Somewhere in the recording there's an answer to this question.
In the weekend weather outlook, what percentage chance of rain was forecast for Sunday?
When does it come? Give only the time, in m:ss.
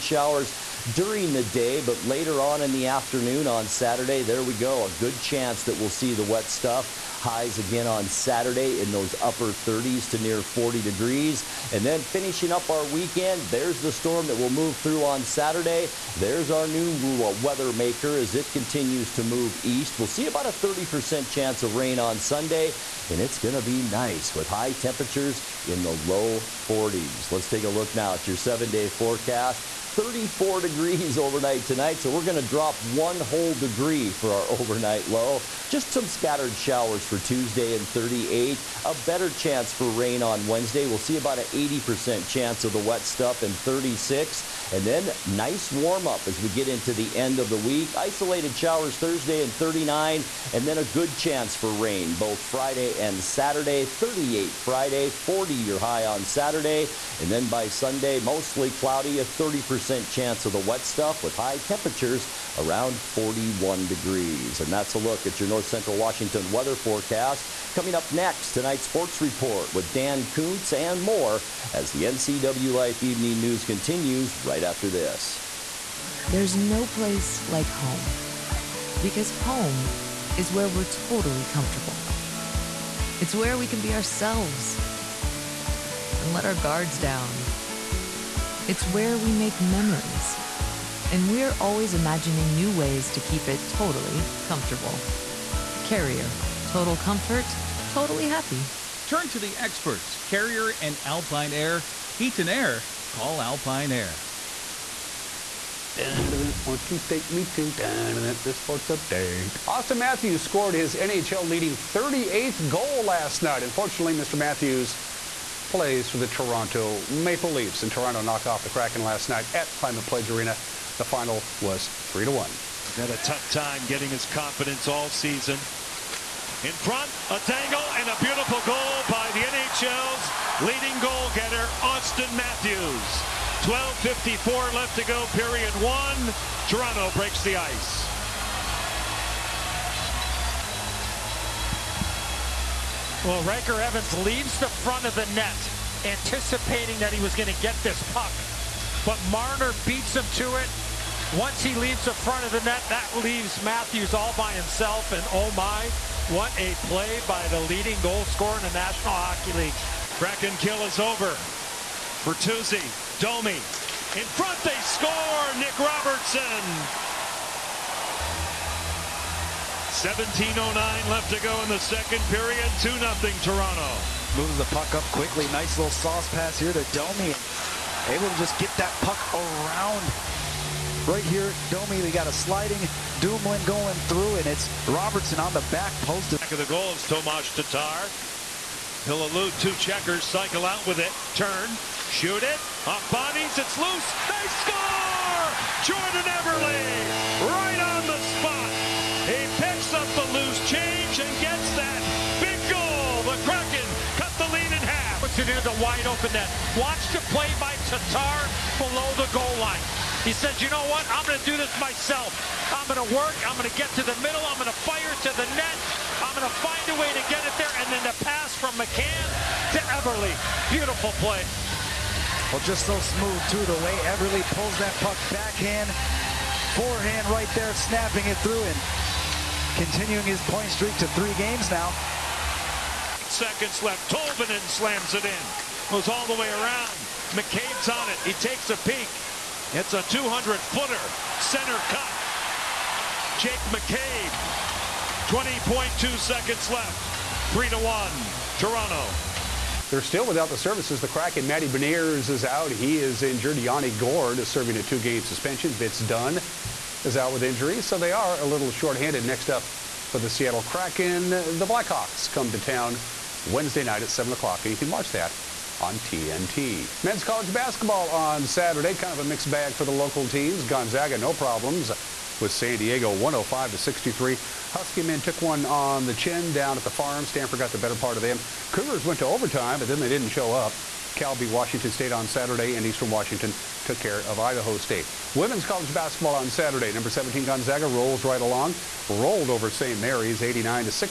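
0:20.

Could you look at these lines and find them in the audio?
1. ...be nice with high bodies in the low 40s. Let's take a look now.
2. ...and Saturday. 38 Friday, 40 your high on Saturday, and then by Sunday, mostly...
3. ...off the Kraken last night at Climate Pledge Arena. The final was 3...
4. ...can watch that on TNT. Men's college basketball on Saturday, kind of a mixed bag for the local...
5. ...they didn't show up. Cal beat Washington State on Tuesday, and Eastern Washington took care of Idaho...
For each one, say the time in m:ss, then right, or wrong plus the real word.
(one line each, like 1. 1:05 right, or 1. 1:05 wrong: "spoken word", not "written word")
1. 0:23 wrong: "temperatures", not "bodies"
2. 0:52 right
3. 1:58 right
4. 4:24 right
5. 4:39 wrong: "Saturday", not "Tuesday".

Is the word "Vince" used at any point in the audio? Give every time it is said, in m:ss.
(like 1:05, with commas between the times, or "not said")
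4:15.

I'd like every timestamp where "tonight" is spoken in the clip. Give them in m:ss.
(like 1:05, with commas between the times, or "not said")
0:31, 1:08.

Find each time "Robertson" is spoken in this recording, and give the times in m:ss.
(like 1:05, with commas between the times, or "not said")
2:45, 3:04.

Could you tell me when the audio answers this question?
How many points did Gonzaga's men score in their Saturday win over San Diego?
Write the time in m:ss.
4:33.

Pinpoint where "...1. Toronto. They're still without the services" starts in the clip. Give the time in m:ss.
4:07.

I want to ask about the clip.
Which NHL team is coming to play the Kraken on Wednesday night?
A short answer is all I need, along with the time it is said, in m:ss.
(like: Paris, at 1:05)
Blackhawks, at 4:21.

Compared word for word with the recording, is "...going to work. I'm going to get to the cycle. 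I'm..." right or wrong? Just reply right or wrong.
wrong.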